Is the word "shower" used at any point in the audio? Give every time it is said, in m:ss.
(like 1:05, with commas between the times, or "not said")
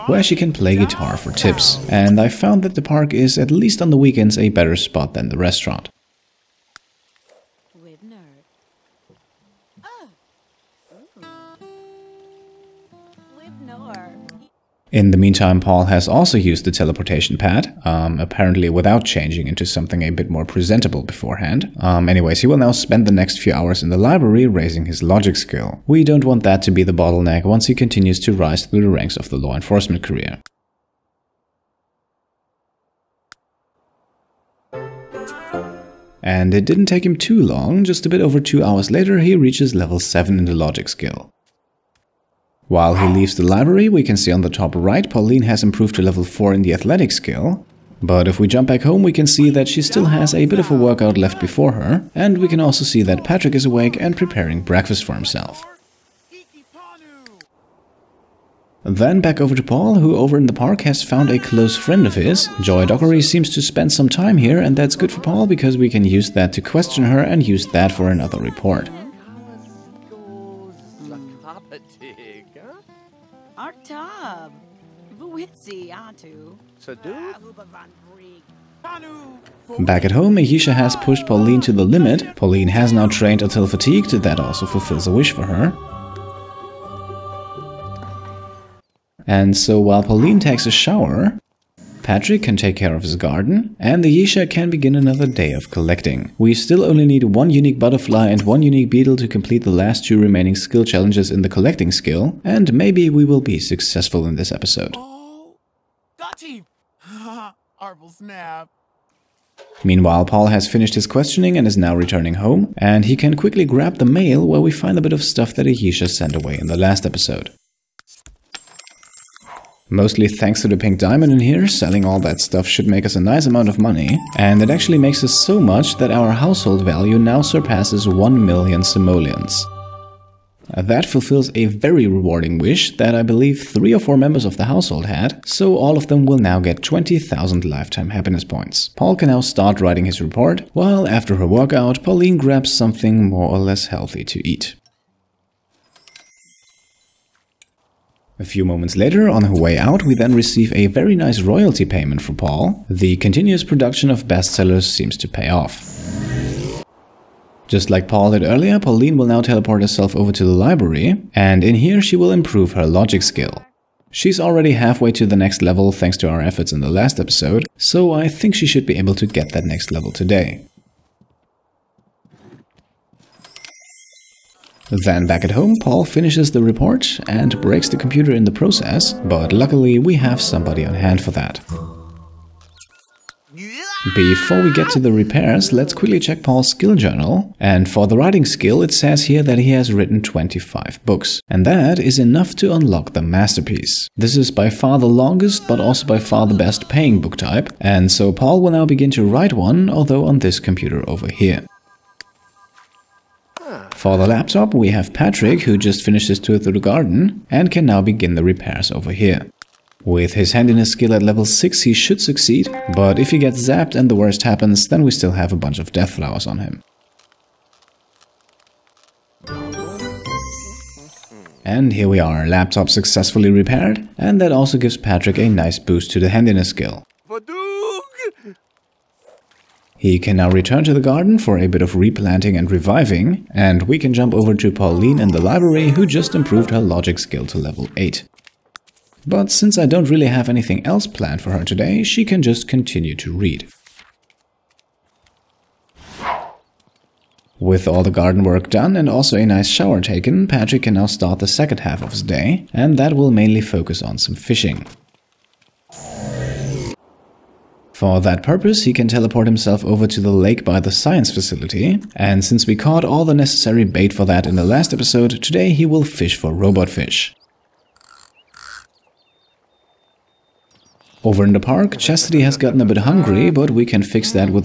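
1:30, 4:09.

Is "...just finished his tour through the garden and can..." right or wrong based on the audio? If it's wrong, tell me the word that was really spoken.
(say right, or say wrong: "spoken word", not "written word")
right.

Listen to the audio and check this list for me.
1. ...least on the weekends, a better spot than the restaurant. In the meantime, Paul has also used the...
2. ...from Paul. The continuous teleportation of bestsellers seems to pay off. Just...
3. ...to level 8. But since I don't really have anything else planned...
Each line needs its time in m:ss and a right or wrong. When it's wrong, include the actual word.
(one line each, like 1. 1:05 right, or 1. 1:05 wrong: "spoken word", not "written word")
1. 0:03 right
2. 2:32 wrong: "production", not "teleportation"
3. 3:57 right.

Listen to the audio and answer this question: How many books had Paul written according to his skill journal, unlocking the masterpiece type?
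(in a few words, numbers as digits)
25.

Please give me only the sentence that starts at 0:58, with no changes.
Then back over to Paul, who over in the park has found a close friend of his.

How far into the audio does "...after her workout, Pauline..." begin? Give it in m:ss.
2:21.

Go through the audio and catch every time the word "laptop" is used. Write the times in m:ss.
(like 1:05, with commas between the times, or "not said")
3:24, 3:42.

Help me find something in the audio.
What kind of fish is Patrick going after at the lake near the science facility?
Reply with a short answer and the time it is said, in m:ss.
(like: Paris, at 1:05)
Robot fish, at 4:26.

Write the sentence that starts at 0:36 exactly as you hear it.
And it didn't take him too long, just a bit over two hours later he reaches level 7 in the logic skill.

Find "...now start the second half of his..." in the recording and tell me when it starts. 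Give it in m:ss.
4:10.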